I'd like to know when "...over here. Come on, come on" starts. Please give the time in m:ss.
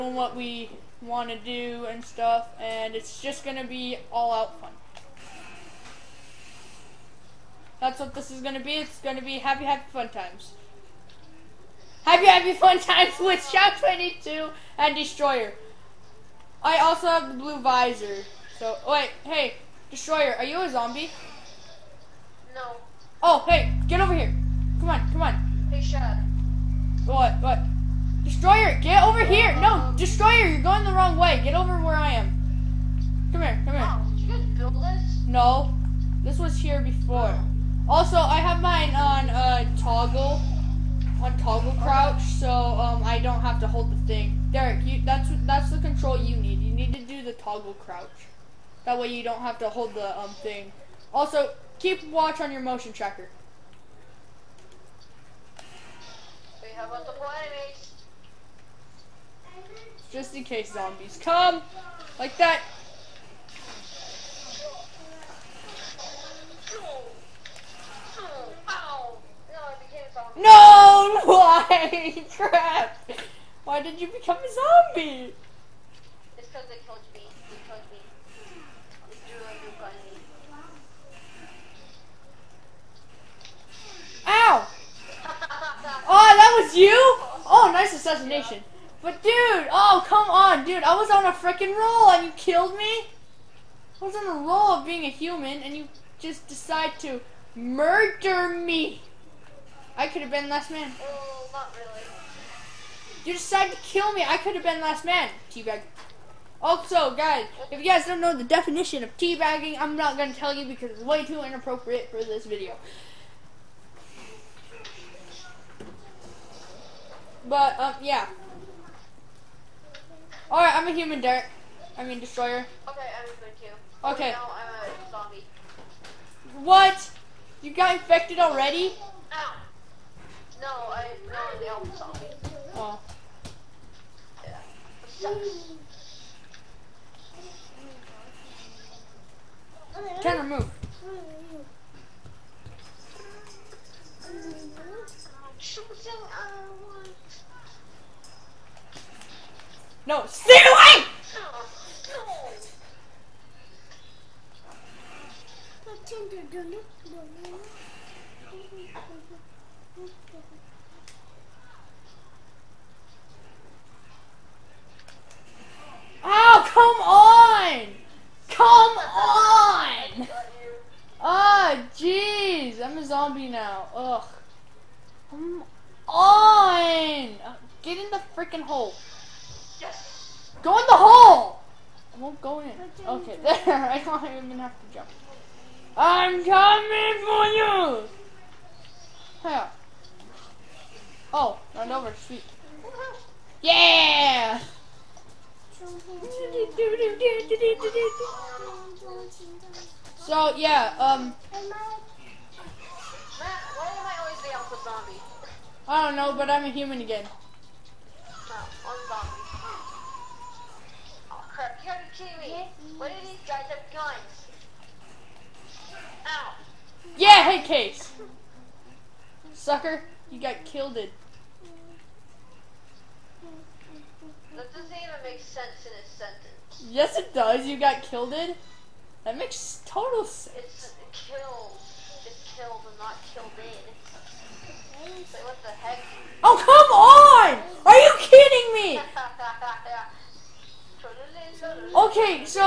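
0:23.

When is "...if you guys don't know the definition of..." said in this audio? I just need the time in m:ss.
1:47.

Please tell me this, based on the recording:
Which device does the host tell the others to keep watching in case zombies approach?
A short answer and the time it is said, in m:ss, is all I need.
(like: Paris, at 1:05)
Motion tracker, at 0:52.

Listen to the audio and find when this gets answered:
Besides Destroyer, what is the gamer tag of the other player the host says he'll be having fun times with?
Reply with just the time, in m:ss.
0:13.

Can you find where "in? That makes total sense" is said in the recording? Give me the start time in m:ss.
3:48.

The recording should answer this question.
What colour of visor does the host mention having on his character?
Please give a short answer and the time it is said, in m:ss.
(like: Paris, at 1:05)
Blue, at 0:17.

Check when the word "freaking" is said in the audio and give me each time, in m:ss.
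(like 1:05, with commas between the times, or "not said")
1:31, 2:58.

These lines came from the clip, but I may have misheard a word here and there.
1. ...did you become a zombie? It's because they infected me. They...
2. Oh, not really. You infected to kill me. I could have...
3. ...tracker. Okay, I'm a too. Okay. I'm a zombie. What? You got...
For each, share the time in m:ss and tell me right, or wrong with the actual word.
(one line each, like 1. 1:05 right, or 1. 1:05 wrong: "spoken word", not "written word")
1. 1:13 wrong: "killed", not "infected"
2. 1:40 wrong: "decided", not "infected"
3. 2:02 wrong: "destroyer", not "tracker".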